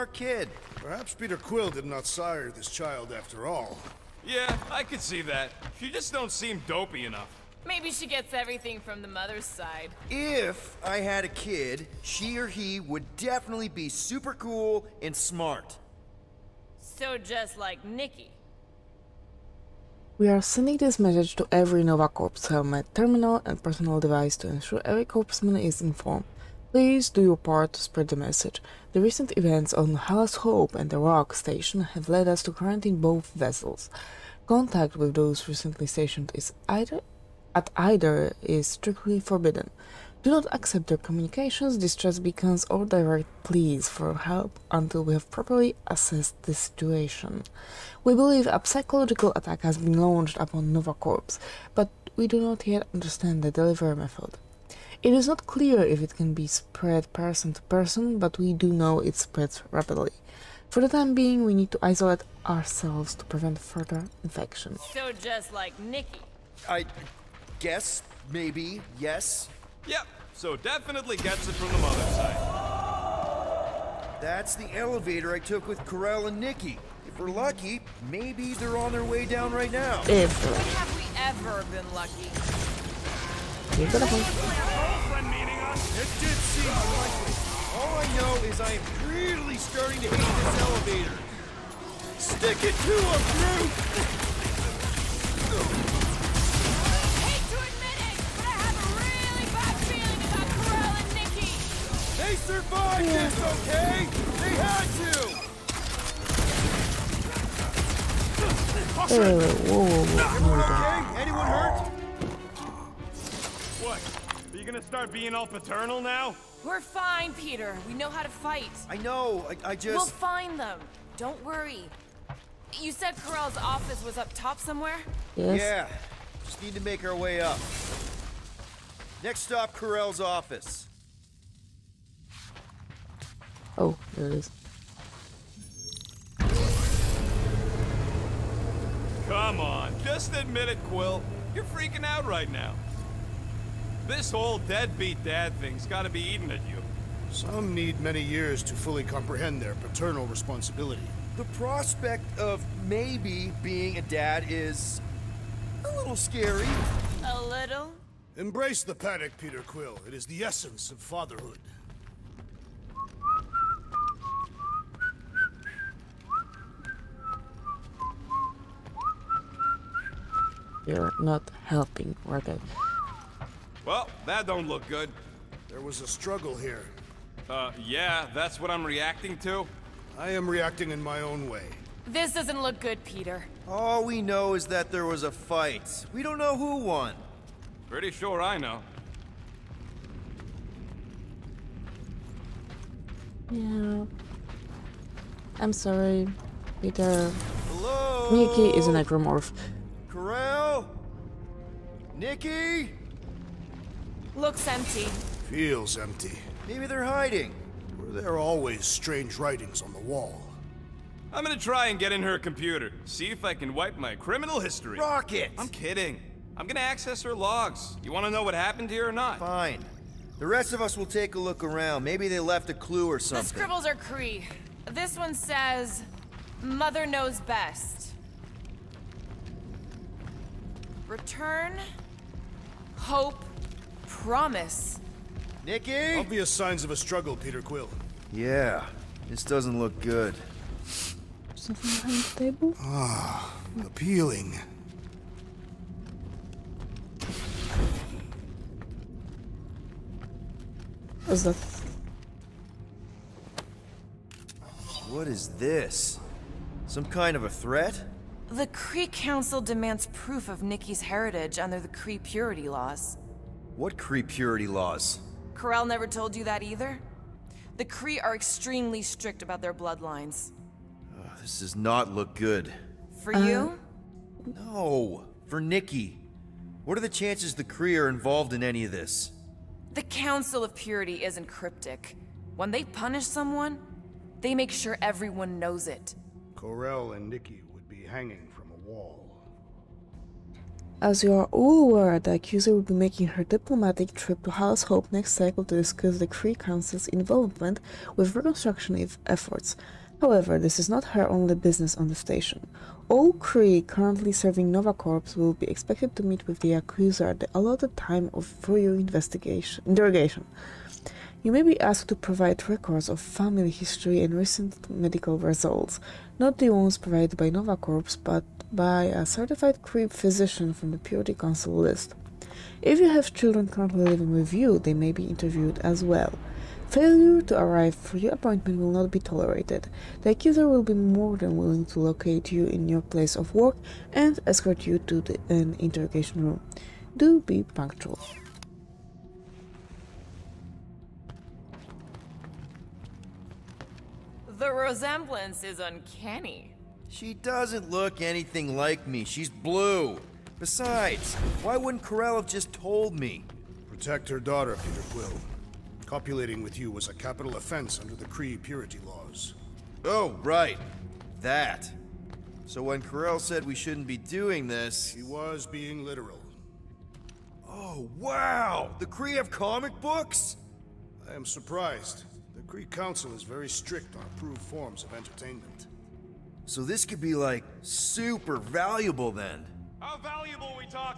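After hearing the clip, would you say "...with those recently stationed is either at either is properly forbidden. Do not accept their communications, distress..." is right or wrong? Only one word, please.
wrong.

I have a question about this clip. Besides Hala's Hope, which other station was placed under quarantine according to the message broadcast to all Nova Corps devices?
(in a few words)
the Rock.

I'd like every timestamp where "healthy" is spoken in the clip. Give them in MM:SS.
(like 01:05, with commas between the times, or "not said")
not said.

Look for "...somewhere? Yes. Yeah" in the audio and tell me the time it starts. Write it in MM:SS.
02:04.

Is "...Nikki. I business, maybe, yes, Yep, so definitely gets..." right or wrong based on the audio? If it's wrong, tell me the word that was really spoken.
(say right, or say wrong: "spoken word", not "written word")
wrong: "guess", not "business".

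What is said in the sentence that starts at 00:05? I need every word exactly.
She just don't seem dopey enough.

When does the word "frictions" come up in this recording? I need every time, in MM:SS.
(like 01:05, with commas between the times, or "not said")
not said.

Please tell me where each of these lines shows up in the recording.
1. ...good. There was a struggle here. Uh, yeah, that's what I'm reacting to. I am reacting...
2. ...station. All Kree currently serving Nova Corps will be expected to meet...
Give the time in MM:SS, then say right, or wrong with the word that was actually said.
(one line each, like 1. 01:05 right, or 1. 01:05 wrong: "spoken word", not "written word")
1. 02:54 right
2. 05:02 right.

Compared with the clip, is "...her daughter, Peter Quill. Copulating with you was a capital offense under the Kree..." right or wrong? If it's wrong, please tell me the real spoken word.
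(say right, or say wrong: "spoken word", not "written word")
right.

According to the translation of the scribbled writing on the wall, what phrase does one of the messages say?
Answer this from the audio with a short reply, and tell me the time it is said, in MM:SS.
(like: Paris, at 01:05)
Mother knows best, at 03:46.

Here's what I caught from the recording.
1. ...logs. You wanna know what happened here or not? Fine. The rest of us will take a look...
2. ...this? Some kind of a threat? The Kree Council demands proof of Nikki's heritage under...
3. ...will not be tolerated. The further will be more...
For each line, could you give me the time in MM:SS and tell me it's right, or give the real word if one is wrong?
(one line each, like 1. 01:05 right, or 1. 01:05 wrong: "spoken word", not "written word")
1. 03:37 right
2. 04:15 right
3. 05:28 wrong: "accuser", not "further".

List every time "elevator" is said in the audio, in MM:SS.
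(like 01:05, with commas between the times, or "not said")
01:14, 01:30.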